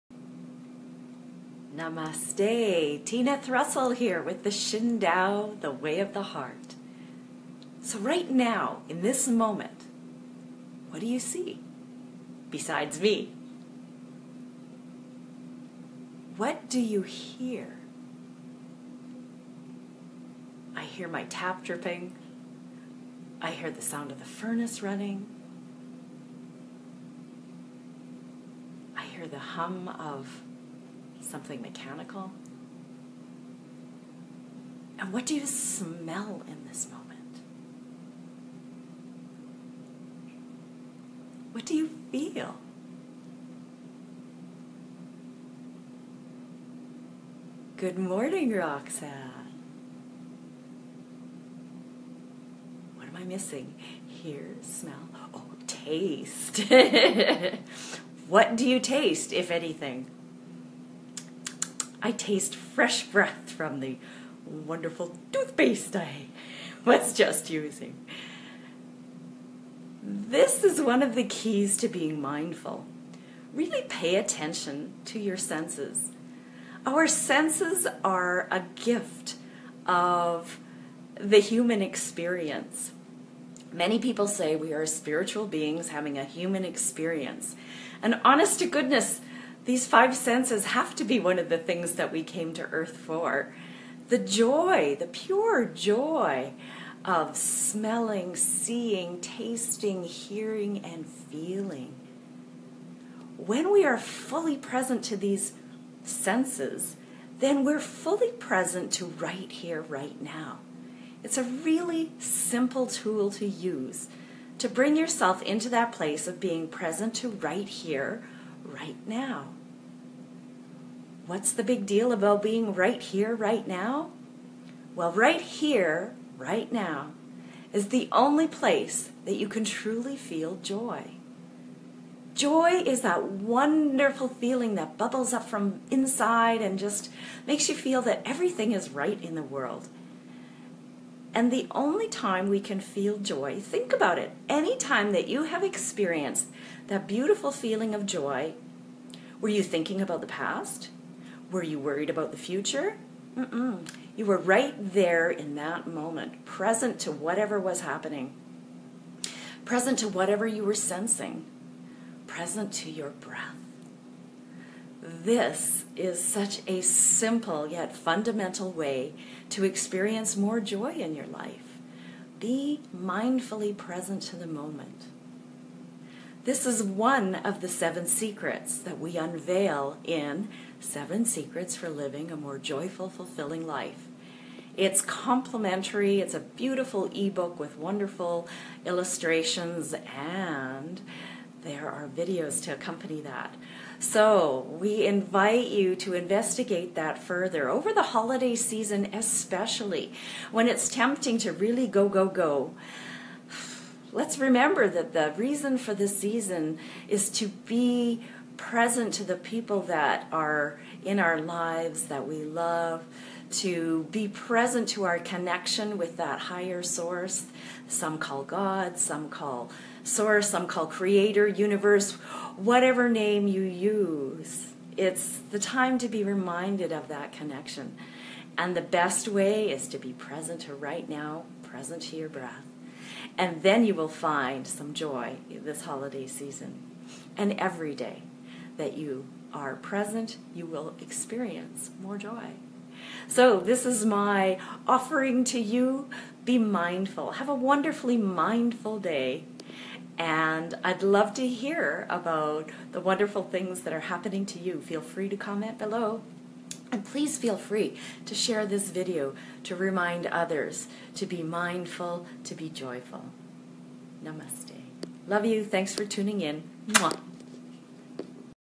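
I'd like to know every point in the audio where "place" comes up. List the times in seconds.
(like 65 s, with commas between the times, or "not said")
115 s, 128 s.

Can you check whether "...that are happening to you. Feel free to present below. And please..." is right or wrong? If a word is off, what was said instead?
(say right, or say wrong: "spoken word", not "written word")
wrong: "comment", not "present".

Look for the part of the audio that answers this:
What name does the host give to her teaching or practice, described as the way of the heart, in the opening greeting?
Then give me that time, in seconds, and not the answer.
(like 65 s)
4 s.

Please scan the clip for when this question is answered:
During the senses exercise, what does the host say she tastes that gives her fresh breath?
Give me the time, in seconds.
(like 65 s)
65 s.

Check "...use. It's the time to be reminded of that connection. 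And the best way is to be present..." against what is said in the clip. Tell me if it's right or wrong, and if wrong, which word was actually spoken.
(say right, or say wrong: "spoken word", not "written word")
right.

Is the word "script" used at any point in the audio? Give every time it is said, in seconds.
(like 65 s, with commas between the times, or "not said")
not said.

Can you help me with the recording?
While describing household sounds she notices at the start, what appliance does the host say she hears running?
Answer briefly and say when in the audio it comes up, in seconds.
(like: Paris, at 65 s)
the furnace, at 24 s.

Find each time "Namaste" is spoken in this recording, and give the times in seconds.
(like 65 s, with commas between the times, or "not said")
1 s, 264 s.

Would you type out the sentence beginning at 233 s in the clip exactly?
And then you will find some joy this holiday season and every day that you are present, you will experience more joy.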